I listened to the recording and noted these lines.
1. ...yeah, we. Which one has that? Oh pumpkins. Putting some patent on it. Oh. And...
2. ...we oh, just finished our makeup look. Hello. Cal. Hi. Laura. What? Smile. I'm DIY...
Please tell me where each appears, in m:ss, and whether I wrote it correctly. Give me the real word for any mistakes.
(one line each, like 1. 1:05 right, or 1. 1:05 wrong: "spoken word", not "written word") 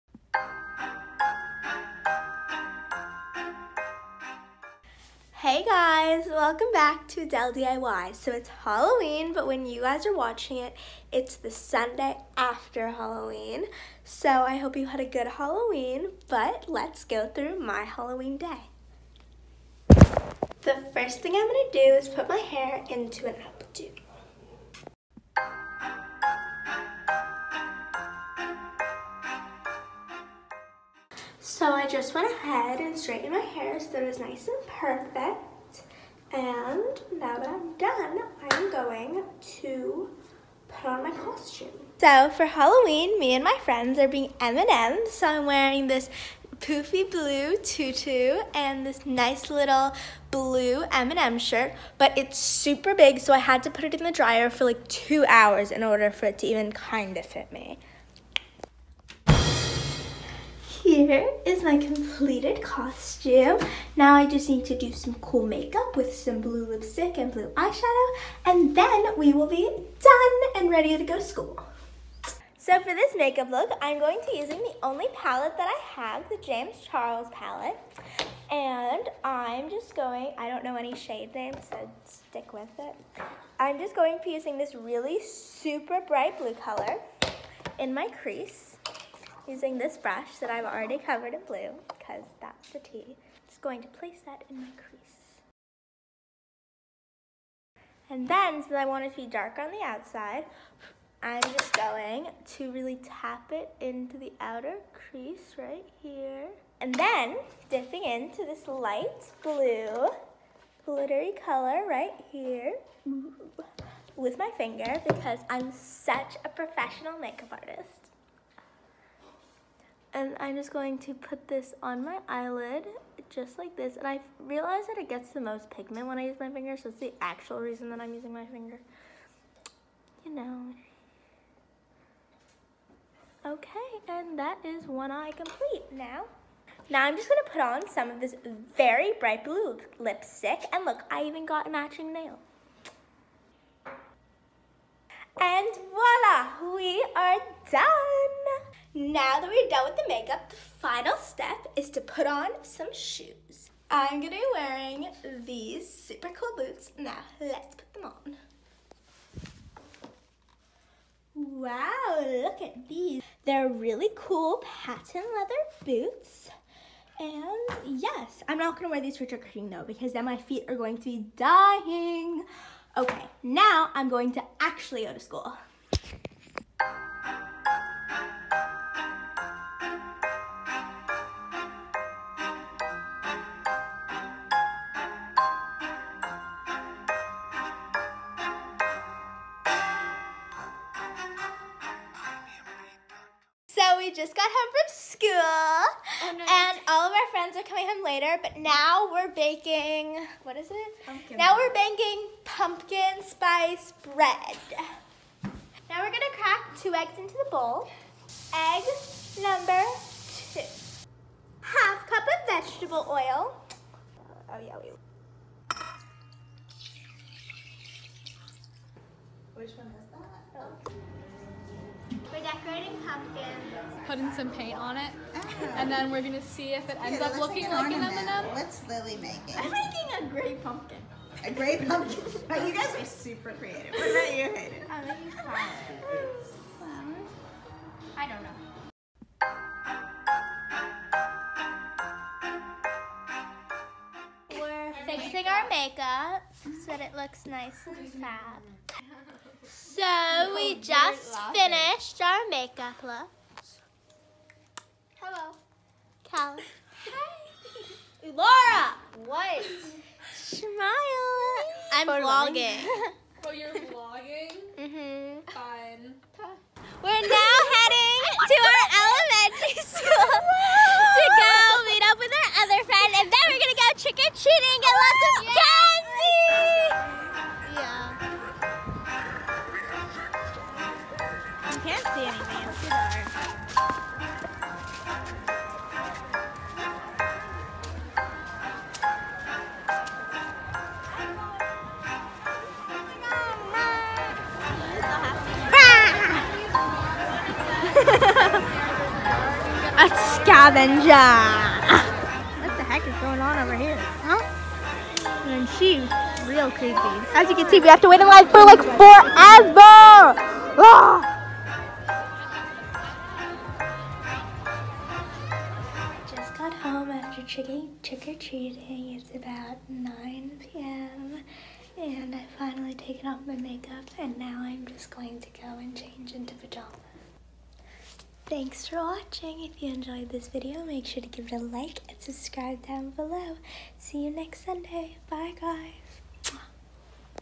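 1. 3:34 wrong: "paint", not "patent"
2. 4:10 wrong: "For", not "DIY".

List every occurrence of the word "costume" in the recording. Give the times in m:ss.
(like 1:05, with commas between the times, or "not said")
0:41, 1:02.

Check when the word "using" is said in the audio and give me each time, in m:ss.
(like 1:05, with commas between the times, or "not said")
1:14, 1:24, 1:29, 2:08.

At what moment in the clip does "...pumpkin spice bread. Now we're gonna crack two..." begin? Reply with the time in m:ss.
3:22.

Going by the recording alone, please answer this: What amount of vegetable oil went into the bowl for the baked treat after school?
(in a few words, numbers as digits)
Half cup.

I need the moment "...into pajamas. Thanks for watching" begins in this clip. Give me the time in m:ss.
5:26.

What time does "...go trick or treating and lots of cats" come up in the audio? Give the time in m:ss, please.
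4:33.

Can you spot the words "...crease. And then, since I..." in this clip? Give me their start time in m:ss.
1:34.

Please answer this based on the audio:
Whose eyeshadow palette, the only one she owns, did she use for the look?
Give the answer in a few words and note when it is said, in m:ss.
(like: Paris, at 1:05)
James Charles, at 1:16.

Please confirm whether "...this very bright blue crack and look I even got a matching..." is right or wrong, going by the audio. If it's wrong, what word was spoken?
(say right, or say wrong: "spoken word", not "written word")
wrong: "lipstick", not "crack".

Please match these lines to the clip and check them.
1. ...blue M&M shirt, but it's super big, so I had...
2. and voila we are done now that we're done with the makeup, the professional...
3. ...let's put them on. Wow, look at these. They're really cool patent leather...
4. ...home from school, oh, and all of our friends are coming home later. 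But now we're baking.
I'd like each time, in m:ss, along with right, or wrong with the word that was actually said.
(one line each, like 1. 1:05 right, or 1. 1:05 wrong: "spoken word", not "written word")
1. 0:50 right
2. 2:25 wrong: "final", not "professional"
3. 2:37 right
4. 3:14 right.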